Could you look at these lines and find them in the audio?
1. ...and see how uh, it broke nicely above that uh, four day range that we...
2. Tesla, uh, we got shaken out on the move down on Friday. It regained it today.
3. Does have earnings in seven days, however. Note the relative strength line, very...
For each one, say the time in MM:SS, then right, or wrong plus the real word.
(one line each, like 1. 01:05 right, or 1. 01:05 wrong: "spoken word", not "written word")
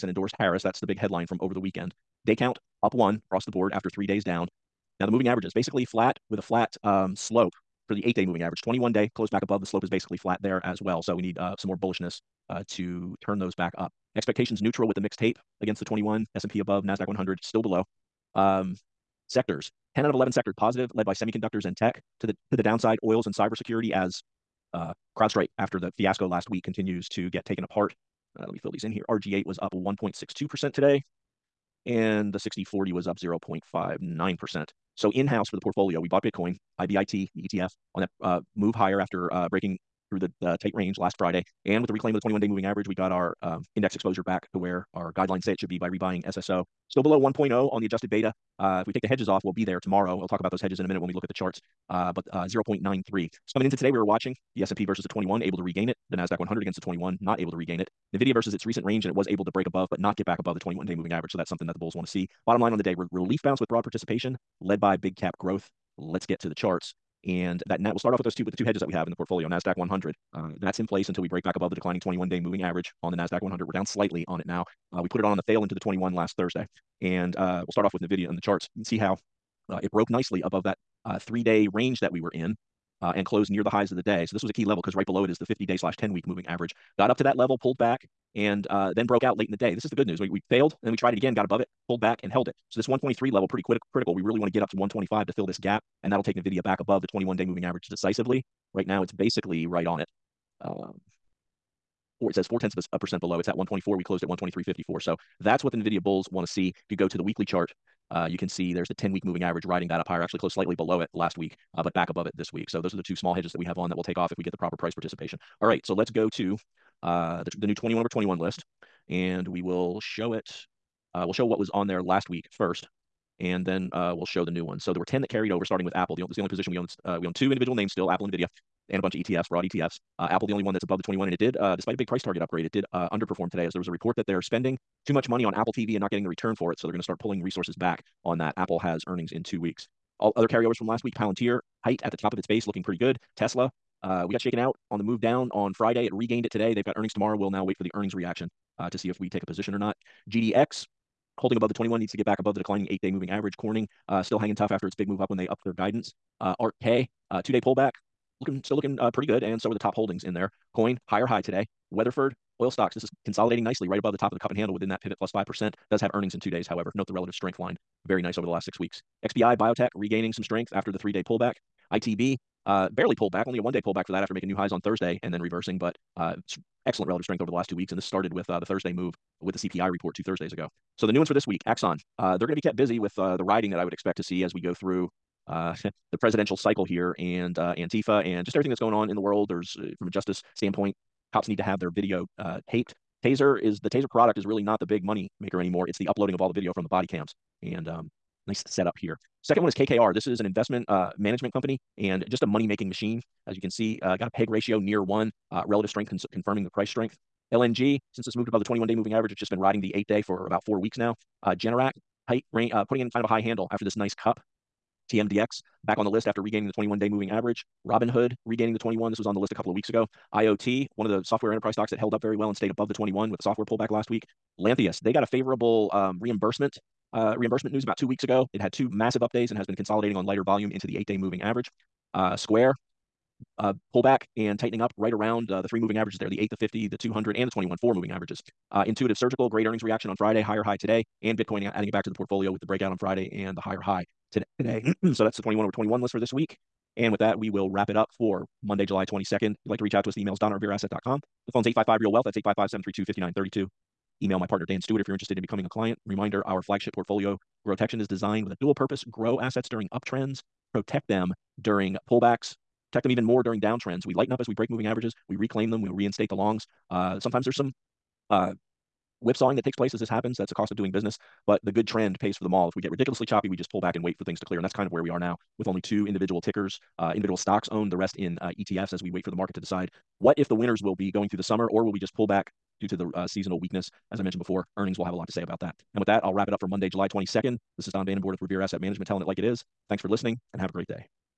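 1. 01:18 wrong: "three", not "four"
2. 02:23 right
3. 02:45 wrong: "two", not "seven".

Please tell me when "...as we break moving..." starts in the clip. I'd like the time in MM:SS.
04:24.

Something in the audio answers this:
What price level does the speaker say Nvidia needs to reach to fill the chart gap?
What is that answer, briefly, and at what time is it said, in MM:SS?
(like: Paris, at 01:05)
125, at 01:34.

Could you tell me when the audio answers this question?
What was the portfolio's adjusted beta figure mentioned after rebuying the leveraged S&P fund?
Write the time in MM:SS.
00:52.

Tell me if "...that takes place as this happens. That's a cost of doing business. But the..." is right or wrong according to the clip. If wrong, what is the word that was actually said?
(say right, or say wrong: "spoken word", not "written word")
right.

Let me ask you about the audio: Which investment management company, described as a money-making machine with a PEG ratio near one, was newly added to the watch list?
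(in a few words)
KKR.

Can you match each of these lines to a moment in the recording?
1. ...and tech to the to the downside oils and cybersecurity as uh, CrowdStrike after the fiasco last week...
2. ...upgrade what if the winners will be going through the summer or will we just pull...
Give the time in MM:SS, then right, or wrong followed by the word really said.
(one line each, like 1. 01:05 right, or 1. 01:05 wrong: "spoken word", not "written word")
1. 00:21 right
2. 04:39 wrong: "decide", not "upgrade".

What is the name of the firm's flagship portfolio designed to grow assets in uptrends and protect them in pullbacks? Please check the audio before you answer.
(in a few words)
Growtection.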